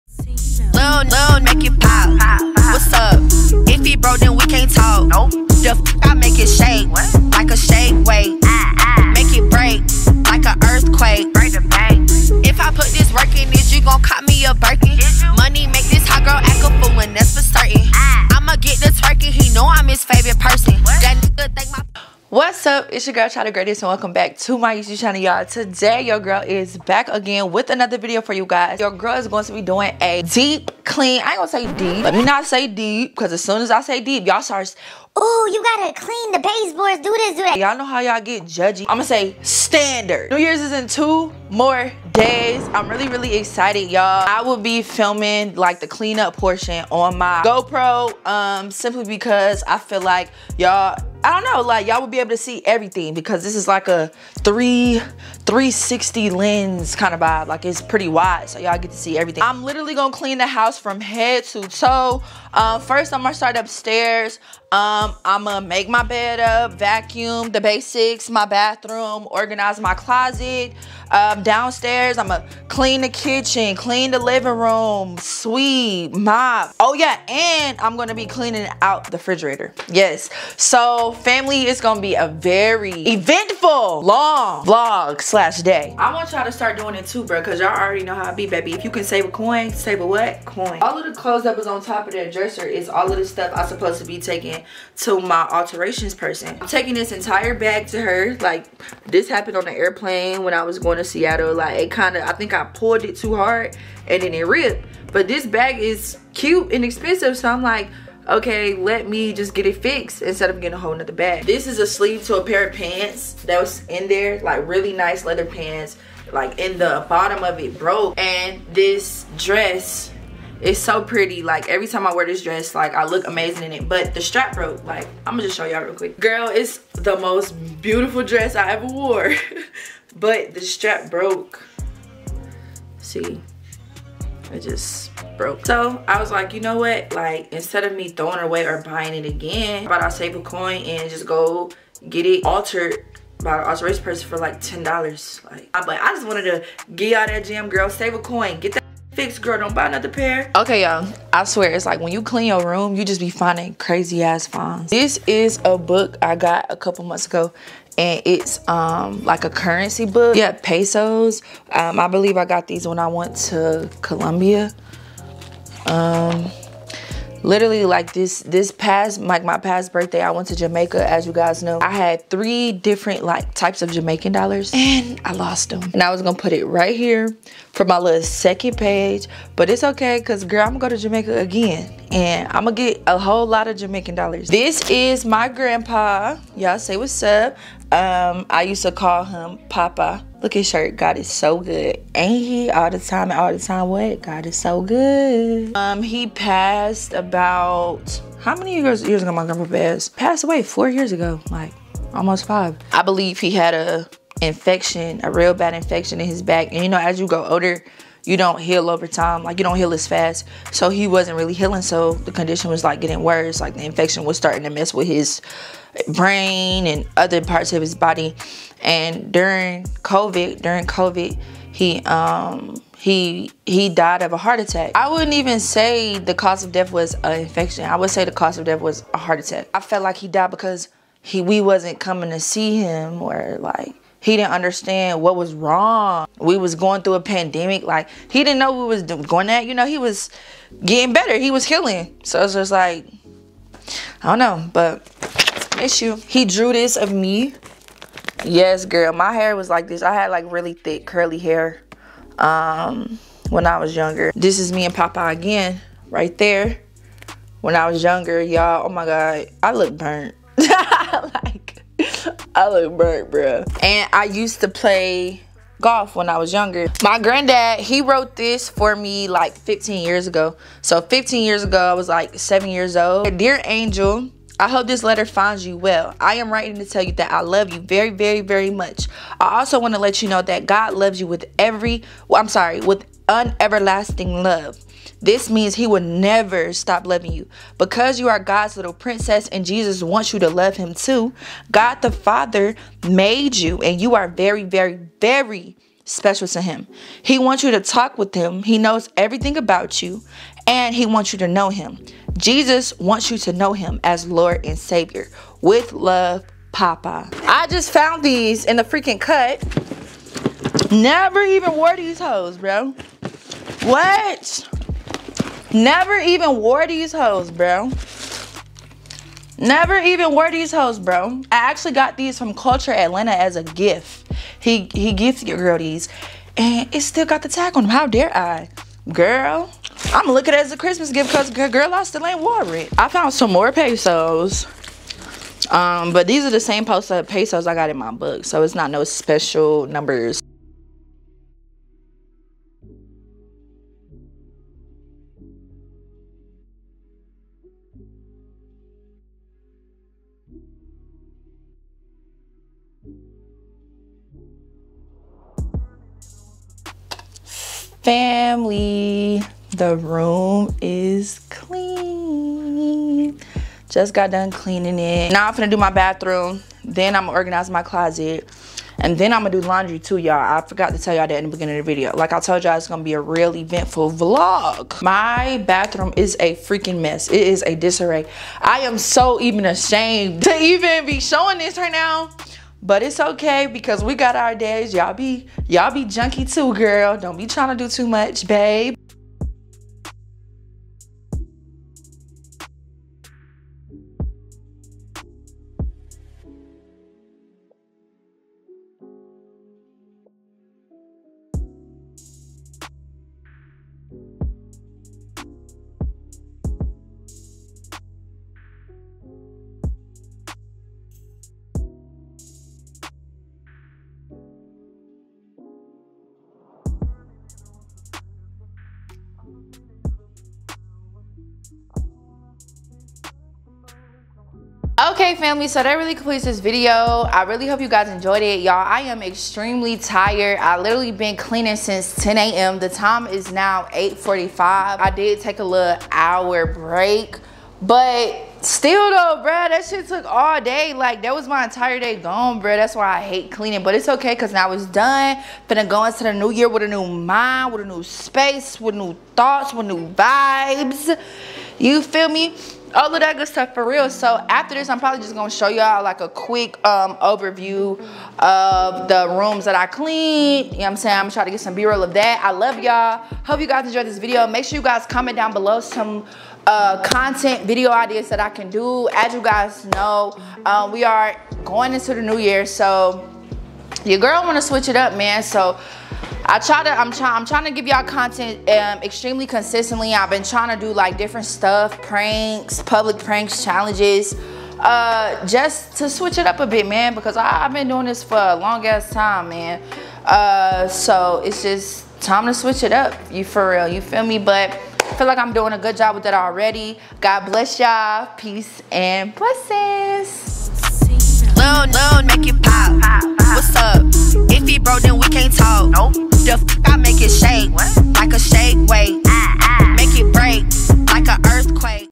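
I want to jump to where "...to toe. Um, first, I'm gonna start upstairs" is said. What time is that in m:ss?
1:01.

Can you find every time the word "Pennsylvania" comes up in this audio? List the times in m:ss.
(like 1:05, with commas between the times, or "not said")
not said.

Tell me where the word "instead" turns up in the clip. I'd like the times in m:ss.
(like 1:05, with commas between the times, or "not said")
1:50, 2:17.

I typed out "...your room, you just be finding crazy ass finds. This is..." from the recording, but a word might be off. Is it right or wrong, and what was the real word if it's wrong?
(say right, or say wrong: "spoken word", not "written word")
right.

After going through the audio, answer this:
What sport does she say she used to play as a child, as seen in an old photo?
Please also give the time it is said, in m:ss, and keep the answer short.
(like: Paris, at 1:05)
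Golf, at 4:25.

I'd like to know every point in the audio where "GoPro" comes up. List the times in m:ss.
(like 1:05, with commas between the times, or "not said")
0:47.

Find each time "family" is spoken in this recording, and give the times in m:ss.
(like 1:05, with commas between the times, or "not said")
1:21, 5:58, 7:05.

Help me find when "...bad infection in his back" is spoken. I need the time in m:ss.
3:25.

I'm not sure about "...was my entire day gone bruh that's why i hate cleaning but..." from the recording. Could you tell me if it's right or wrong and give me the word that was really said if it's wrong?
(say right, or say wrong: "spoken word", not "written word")
right.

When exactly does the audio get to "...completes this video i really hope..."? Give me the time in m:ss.
7:06.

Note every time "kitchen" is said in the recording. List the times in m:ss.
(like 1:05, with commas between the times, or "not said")
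1:13.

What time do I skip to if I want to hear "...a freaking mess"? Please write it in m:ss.
6:16.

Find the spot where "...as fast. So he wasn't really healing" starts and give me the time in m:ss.
3:29.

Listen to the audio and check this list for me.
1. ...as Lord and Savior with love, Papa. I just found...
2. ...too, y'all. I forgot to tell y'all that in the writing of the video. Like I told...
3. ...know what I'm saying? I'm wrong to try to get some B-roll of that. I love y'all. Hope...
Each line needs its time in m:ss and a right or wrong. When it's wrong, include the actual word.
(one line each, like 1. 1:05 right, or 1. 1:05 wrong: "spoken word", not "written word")
1. 5:04 right
2. 6:09 wrong: "beginning", not "writing"
3. 7:40 wrong: "trying", not "wrong".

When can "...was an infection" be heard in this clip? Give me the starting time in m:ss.
3:46.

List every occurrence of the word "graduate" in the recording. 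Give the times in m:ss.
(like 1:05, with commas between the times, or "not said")
not said.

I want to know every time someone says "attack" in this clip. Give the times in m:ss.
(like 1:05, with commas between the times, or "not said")
3:44, 3:49.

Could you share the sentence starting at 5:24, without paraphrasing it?
He he gifted your girl these.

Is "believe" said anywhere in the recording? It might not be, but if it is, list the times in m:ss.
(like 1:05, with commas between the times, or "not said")
2:42, 3:23.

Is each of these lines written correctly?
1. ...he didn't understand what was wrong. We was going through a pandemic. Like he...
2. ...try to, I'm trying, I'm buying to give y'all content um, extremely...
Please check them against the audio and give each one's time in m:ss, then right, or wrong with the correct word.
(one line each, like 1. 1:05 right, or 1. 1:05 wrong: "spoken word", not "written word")
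1. 3:54 right
2. 7:56 wrong: "trying", not "buying".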